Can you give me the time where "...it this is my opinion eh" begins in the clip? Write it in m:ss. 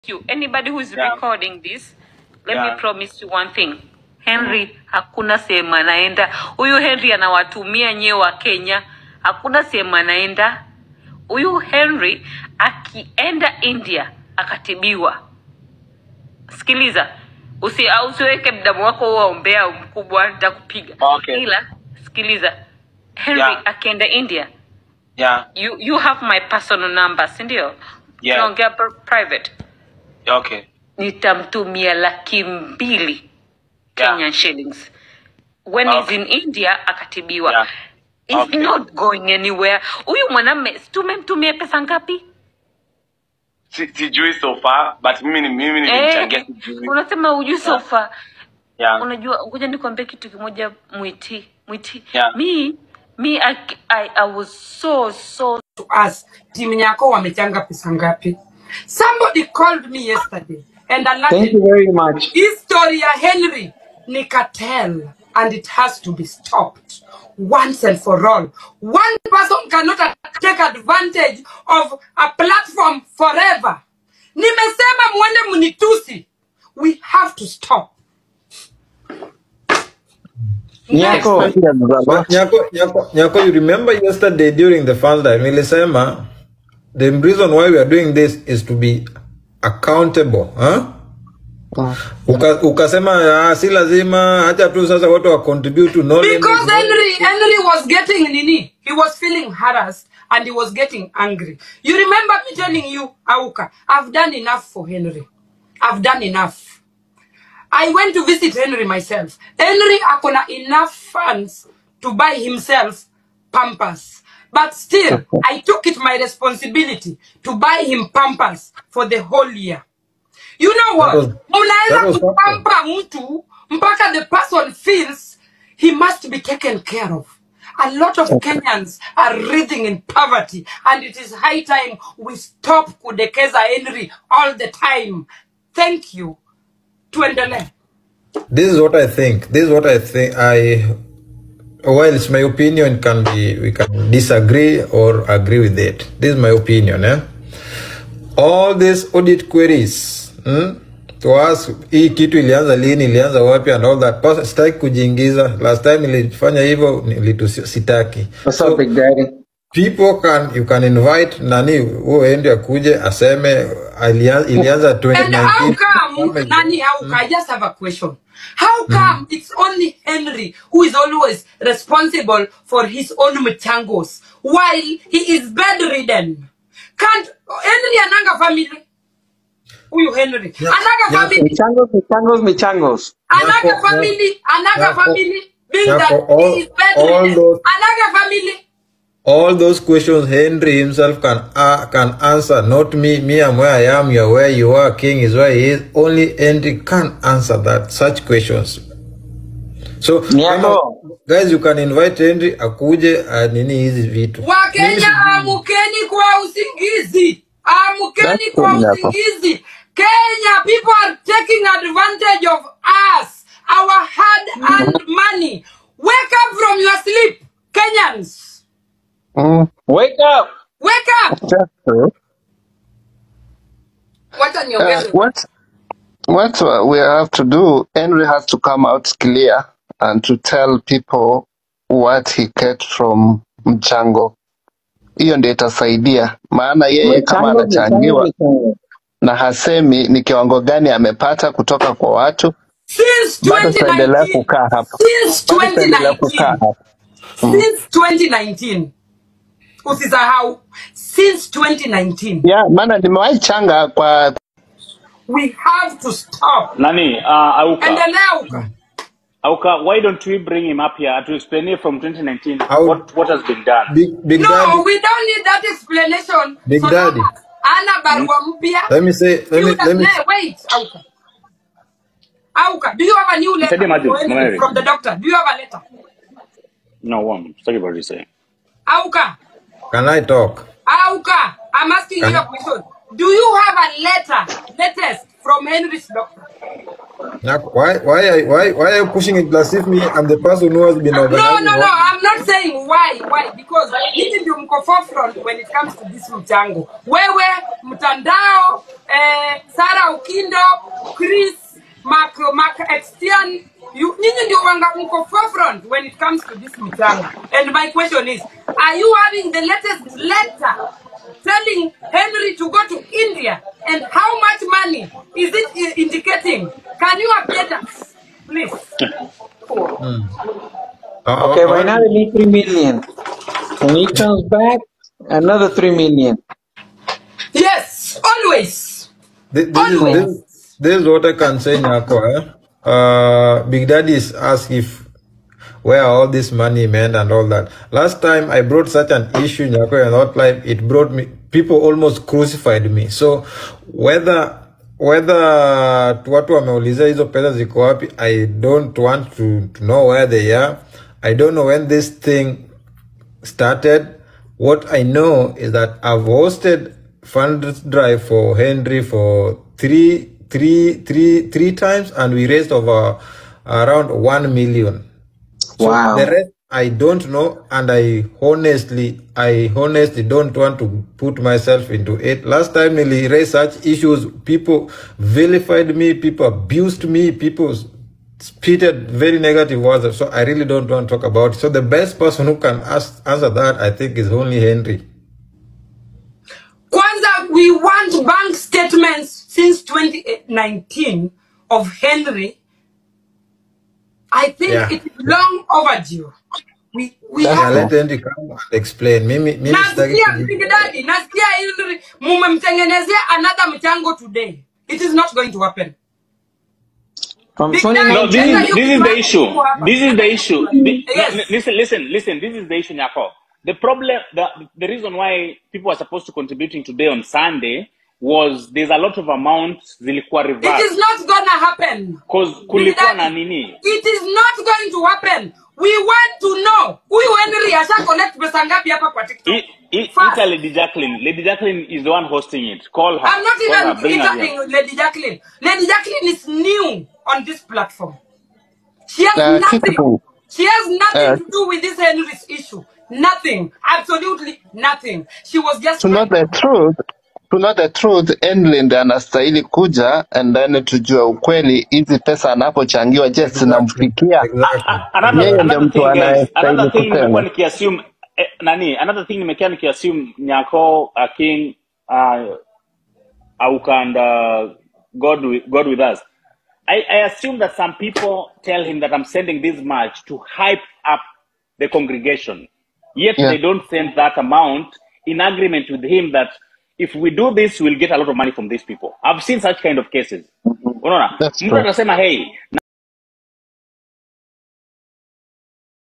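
2:25.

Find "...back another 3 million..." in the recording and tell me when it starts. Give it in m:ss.
5:24.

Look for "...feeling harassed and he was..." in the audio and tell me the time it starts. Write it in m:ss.
1:39.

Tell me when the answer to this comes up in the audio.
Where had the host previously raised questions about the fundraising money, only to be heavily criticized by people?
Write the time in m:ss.
5:39.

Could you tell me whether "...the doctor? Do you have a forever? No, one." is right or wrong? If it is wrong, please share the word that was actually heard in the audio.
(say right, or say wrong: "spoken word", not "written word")
wrong: "letter", not "forever".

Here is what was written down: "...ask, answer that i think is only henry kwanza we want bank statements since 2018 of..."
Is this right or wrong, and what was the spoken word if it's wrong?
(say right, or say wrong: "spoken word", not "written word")
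wrong: "2019", not "2018".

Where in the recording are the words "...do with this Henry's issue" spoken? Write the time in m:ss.
7:21.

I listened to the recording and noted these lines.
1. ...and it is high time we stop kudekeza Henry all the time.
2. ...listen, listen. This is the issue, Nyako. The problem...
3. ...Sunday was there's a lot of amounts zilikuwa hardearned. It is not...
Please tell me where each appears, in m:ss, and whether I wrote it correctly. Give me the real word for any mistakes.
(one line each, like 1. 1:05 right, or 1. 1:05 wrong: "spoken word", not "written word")
1. 2:10 right
2. 6:51 right
3. 6:57 wrong: "reversed", not "hardearned".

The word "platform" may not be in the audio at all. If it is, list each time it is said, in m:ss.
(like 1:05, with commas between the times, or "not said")
1:12, 7:17.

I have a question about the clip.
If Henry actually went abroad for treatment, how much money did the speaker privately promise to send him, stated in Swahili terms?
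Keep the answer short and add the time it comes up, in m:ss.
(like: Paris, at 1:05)
laki mbili (200,000 shillings), at 0:31.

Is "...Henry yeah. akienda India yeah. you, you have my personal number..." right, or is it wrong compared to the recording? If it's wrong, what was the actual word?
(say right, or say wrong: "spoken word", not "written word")
right.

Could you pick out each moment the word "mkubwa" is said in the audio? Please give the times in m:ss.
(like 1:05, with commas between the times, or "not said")
0:19.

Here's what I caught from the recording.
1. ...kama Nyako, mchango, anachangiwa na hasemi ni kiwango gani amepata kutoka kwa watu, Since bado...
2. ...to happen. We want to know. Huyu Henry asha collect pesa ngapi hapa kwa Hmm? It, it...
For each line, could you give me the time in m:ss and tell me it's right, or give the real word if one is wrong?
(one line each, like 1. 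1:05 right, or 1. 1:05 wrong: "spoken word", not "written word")
1. 3:57 wrong: "Mchango", not "Nyako"
2. 7:04 wrong: "TikTok", not "Hmm".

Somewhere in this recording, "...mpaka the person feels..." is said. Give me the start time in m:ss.
2:03.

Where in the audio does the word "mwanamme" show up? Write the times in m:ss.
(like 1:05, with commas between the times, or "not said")
0:40.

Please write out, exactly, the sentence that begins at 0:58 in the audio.
Somebody called me yesterday and I Thank you very much.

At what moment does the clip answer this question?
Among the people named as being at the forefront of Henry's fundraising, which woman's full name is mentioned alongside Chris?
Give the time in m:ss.
4:59.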